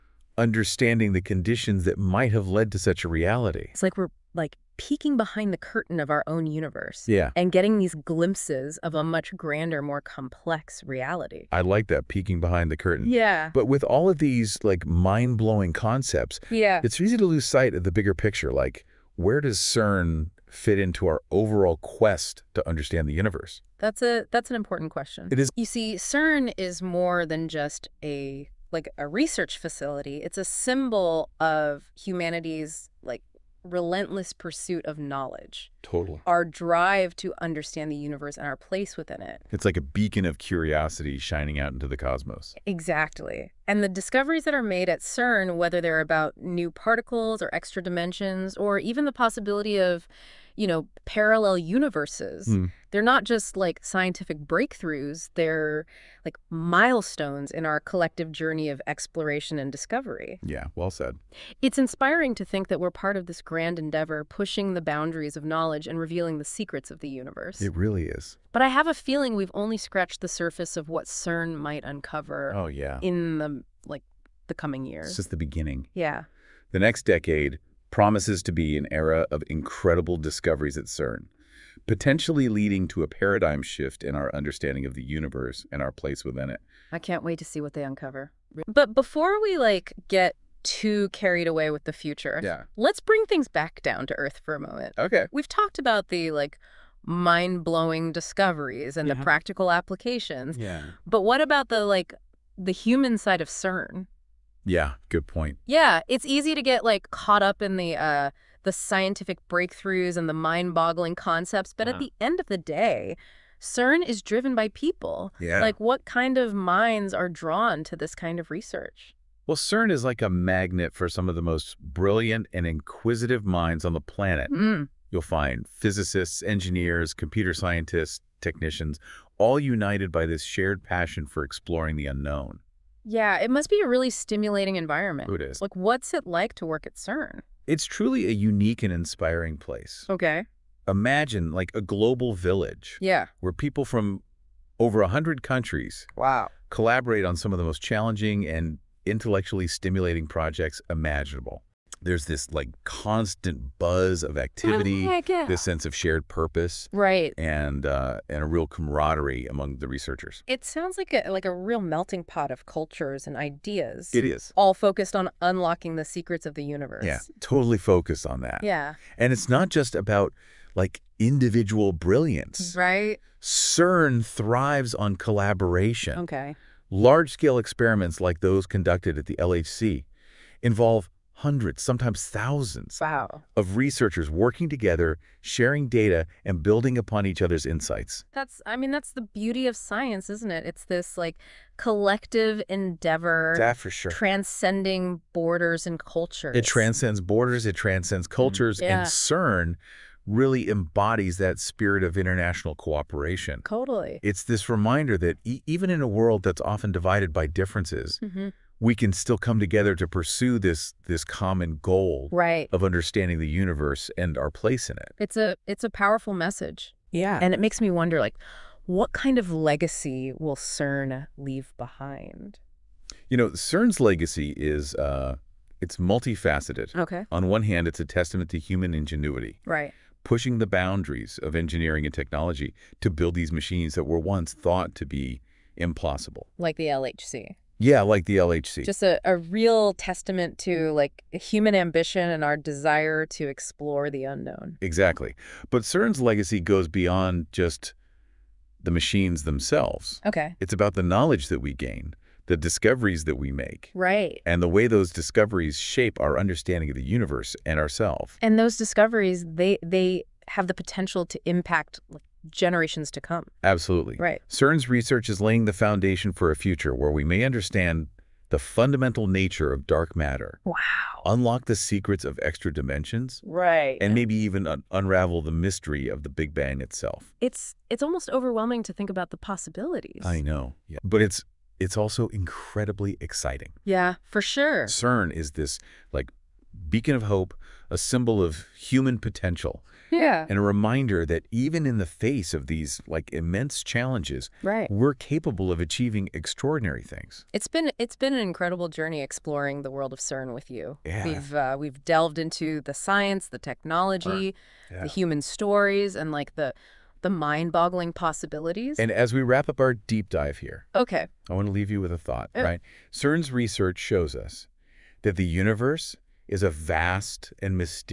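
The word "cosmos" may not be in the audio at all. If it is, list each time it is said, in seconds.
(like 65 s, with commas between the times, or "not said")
41 s.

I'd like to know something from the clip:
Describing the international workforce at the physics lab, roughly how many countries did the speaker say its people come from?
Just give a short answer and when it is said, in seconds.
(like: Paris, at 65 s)
over 100, at 144 s.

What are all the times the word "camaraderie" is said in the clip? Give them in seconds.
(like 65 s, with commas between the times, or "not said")
158 s.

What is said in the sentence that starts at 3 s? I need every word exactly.
It's like we're like peeking behind the curtain of our own universe yeah.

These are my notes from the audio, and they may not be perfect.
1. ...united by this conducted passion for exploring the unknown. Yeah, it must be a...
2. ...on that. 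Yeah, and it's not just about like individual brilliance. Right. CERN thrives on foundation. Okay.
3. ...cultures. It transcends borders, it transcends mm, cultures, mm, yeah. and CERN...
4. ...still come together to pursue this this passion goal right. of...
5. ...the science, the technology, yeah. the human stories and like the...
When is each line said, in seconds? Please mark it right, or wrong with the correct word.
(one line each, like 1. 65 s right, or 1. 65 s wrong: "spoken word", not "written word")
1. 129 s wrong: "shared", not "conducted"
2. 168 s wrong: "collaboration", not "foundation"
3. 195 s right
4. 209 s wrong: "common", not "passion"
5. 302 s right.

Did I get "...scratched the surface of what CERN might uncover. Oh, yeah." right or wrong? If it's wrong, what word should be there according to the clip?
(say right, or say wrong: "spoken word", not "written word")
right.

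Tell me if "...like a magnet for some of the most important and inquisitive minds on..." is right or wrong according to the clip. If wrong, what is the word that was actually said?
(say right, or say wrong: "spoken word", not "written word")
wrong: "brilliant", not "important".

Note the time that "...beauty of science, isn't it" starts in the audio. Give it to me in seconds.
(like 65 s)
189 s.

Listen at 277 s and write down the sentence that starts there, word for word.
It's it's almost overwhelming to think about the possibilities.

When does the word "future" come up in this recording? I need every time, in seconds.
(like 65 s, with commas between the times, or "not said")
91 s, 266 s.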